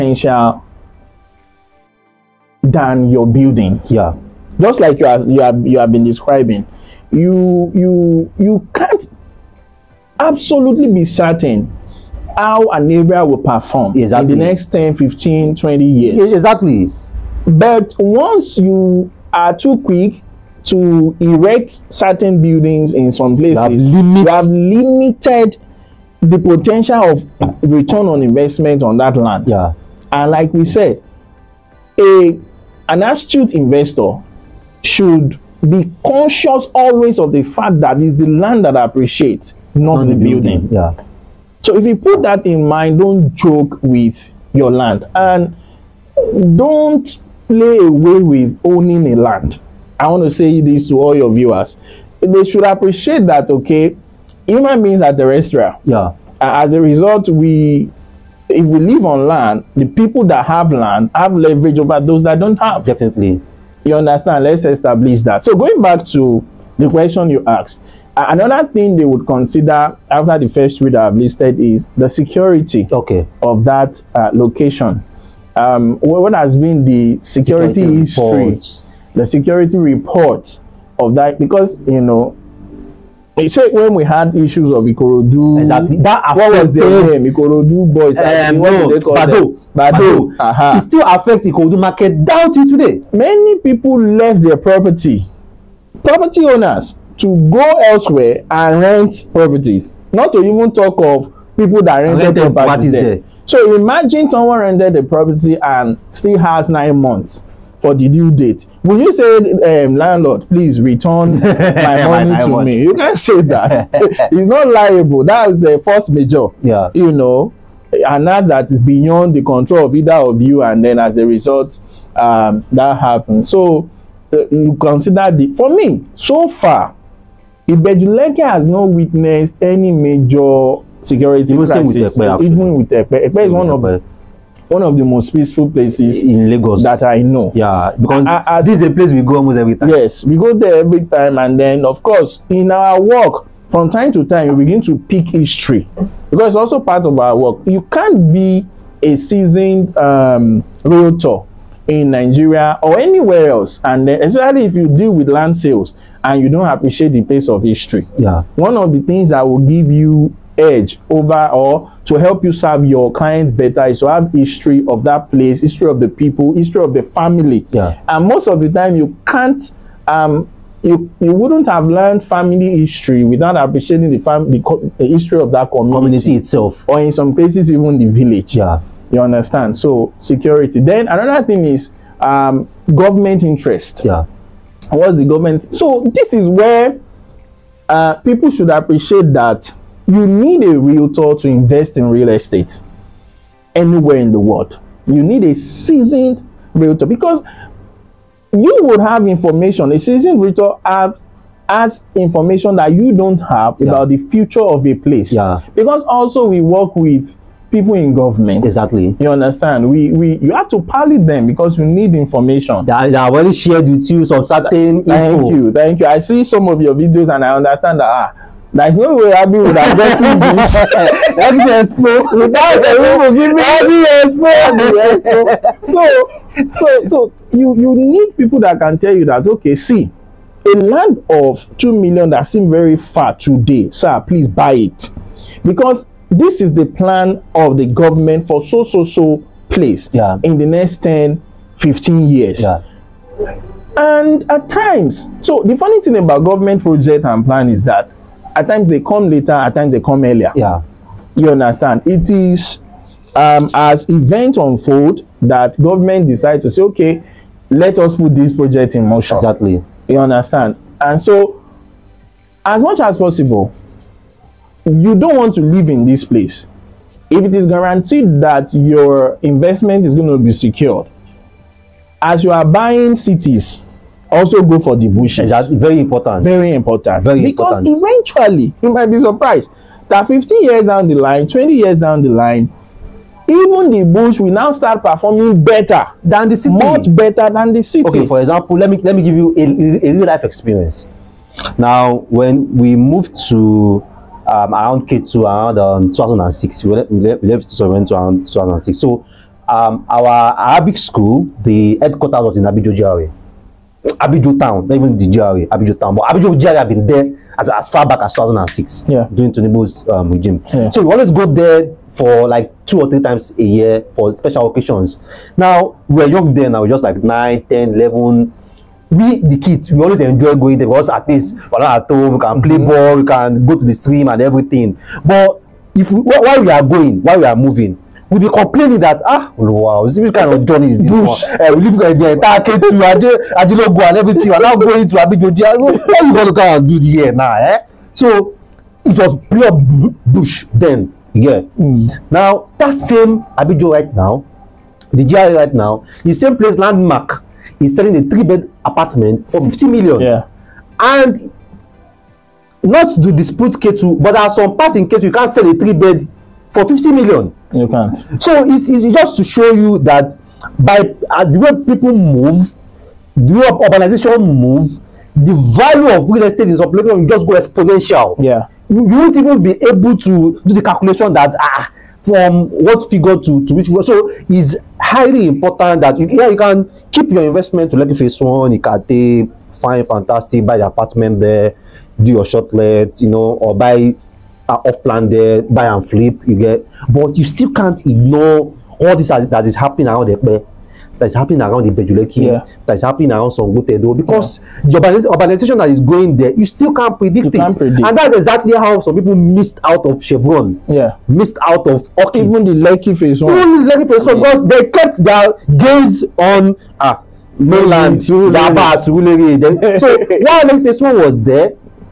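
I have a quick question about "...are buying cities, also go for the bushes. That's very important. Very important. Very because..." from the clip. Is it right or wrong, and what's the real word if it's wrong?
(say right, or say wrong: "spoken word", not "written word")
right.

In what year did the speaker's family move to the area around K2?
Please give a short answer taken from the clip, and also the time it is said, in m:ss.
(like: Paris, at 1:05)
2006, at 4:55.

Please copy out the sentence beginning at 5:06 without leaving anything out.
But Abidjo GRA had been there as, as far back as 2006, yeah.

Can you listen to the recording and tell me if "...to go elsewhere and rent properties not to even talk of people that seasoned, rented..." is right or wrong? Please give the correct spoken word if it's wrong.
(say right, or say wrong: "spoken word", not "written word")
wrong: "rented", not "seasoned".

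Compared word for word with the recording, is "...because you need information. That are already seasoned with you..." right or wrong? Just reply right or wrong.
wrong.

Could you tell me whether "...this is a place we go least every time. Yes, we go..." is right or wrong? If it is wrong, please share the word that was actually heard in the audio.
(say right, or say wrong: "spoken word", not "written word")
wrong: "almost", not "least".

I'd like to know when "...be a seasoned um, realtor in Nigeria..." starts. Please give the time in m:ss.
2:28.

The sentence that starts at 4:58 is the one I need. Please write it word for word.
So um, our Arabic school, the headquarters was in Abidjo GRA.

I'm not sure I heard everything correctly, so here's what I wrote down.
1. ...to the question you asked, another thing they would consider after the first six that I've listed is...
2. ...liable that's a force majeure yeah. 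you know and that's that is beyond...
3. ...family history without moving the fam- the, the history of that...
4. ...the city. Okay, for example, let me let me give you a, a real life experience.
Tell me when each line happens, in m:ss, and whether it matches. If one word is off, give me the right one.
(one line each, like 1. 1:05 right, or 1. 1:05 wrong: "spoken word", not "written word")
1. 1:06 wrong: "three", not "six"
2. 1:54 right
3. 2:52 wrong: "appreciating", not "moving"
4. 4:47 right.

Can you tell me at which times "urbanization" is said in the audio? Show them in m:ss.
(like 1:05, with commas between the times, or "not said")
6:03, 6:35.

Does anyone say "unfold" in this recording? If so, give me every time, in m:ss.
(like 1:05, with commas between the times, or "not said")
4:14.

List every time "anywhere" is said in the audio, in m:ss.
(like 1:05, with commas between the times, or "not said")
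2:32, 3:13.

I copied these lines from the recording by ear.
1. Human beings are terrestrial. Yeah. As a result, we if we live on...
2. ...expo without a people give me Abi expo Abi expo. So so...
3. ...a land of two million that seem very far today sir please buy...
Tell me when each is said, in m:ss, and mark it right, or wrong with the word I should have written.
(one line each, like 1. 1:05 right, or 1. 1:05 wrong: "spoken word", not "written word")
1. 0:54 right
2. 3:41 right
3. 3:50 right.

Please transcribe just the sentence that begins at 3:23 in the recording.
about the future of a place yeah.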